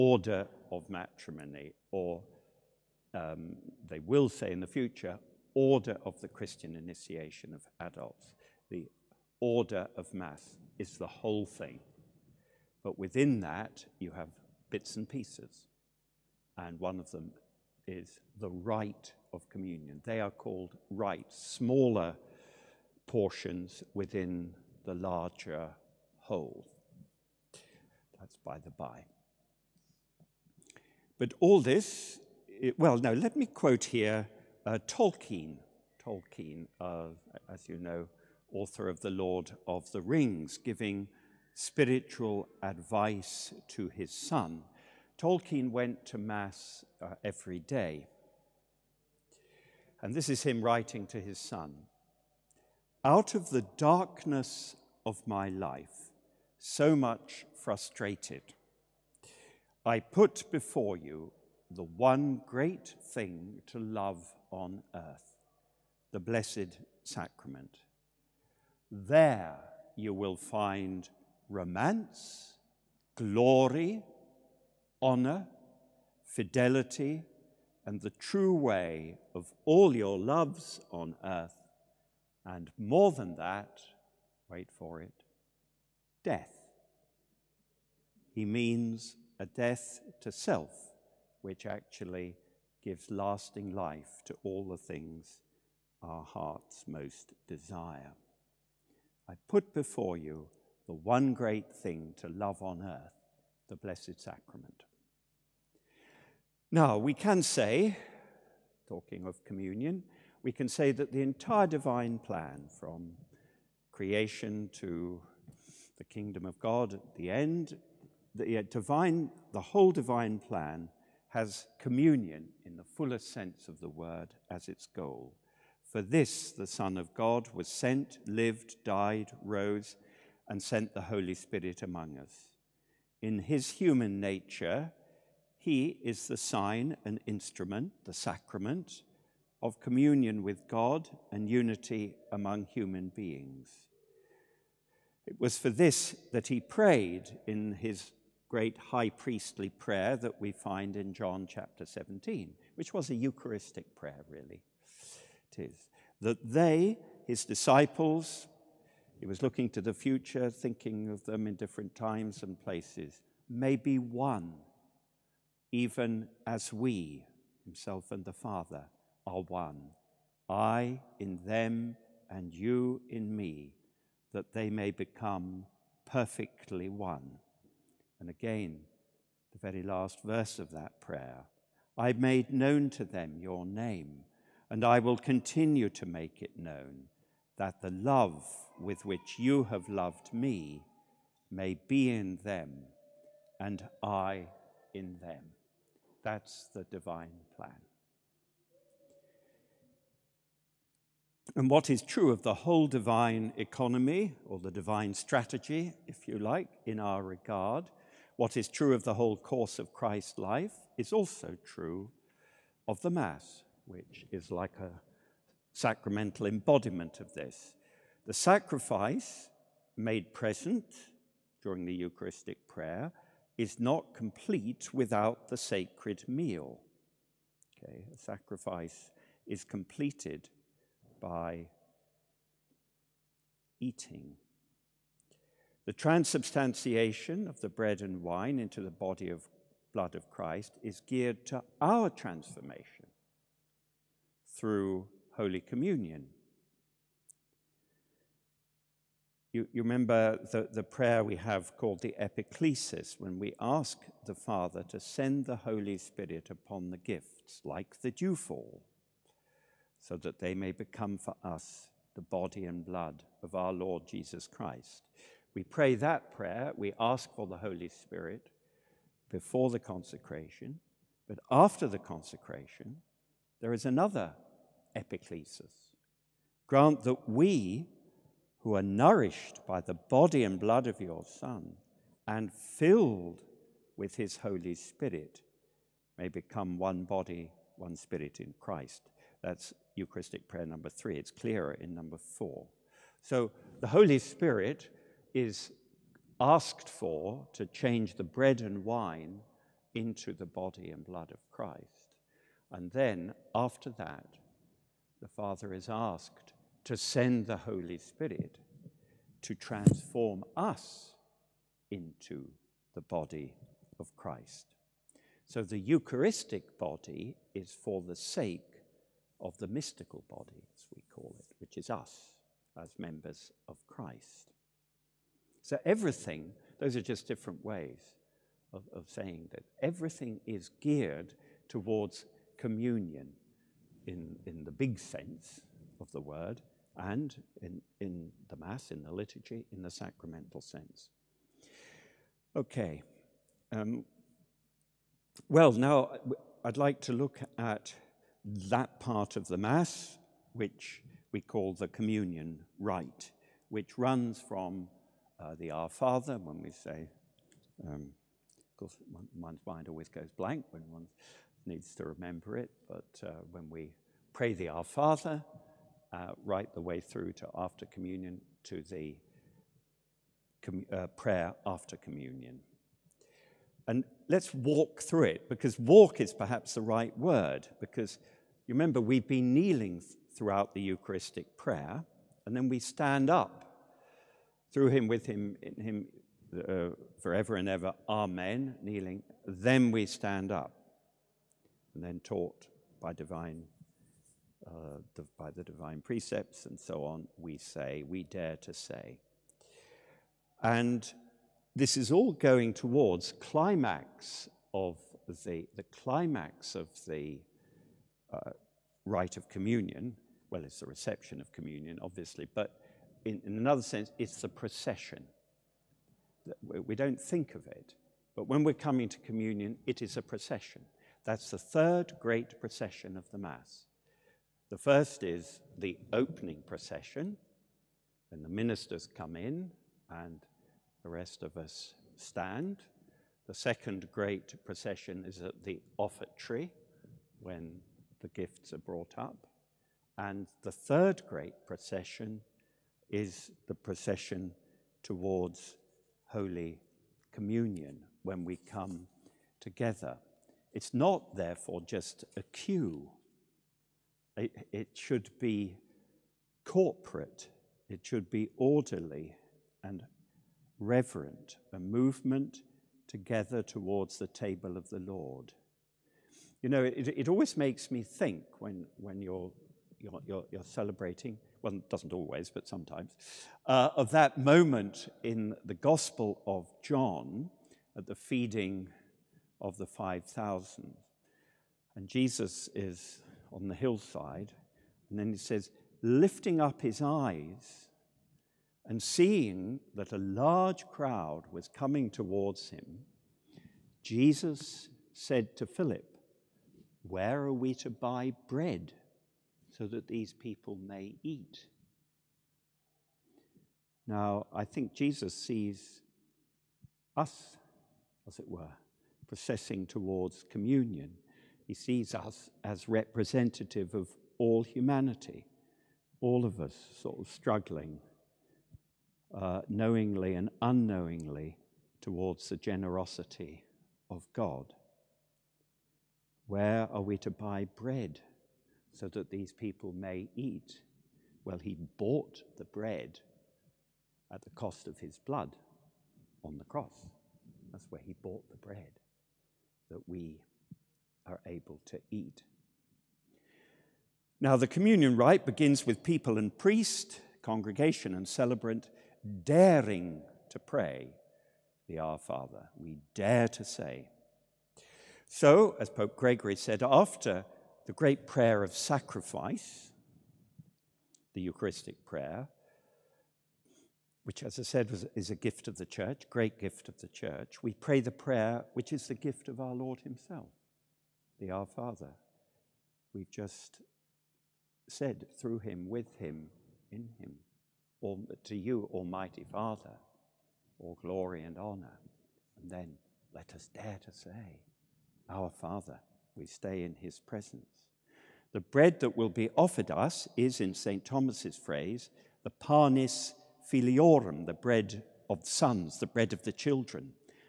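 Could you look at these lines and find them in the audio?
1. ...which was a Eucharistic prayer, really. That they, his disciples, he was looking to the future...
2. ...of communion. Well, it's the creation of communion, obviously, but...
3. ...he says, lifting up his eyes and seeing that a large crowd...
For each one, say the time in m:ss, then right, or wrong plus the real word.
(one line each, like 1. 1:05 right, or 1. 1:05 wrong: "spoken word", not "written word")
1. 2:32 right
2. 6:49 wrong: "reception", not "creation"
3. 8:05 right.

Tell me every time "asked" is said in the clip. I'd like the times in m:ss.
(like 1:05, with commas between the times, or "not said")
4:56, 5:05.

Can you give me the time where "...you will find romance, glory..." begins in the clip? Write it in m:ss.
1:09.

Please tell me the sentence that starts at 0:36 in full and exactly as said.
Tolkien, uh, as you know, author of The Lord of the Rings, giving spiritual advice to his son.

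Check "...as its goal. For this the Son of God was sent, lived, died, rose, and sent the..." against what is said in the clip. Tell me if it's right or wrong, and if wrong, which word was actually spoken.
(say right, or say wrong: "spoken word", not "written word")
right.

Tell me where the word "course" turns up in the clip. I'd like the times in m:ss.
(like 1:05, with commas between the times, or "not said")
3:29, 5:58.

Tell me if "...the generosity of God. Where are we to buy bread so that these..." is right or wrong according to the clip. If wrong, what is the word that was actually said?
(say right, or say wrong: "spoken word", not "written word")
right.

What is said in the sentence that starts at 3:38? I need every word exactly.
The sacrifice made present during the Eucharistic prayer is not complete without the sacred meal.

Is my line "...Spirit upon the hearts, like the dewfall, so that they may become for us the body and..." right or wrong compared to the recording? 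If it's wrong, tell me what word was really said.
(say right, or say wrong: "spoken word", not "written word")
wrong: "gifts", not "hearts".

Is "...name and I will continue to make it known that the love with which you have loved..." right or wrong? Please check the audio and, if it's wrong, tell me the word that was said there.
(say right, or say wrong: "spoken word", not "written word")
right.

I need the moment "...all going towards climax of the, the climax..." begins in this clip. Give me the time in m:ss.
6:42.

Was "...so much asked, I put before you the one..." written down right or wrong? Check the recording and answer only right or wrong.
wrong.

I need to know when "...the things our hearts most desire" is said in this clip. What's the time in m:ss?
1:34.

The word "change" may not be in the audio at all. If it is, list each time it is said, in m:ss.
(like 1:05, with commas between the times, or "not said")
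4:57.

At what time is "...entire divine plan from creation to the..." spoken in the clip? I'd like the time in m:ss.
1:51.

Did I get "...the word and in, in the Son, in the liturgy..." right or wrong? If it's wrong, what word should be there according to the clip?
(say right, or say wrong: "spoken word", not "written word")
wrong: "Mass", not "Son".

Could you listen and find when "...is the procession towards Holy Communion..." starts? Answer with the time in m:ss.
7:23.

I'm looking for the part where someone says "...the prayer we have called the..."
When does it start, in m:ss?
4:10.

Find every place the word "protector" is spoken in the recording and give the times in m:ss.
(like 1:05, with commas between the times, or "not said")
not said.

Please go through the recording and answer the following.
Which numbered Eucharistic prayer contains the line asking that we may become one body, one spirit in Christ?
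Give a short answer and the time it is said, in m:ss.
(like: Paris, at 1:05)
3, at 4:50.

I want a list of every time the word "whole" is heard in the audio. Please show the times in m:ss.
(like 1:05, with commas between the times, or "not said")
0:11, 0:26, 1:59, 3:22, 3:29.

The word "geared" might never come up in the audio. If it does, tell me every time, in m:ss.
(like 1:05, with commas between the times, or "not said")
4:01, 5:30.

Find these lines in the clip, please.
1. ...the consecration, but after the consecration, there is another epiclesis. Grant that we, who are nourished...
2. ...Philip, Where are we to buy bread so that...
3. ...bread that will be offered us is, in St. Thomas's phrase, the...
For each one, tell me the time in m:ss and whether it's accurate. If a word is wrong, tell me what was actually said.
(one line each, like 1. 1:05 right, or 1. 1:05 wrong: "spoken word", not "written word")
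1. 4:29 right
2. 8:15 right
3. 9:48 right.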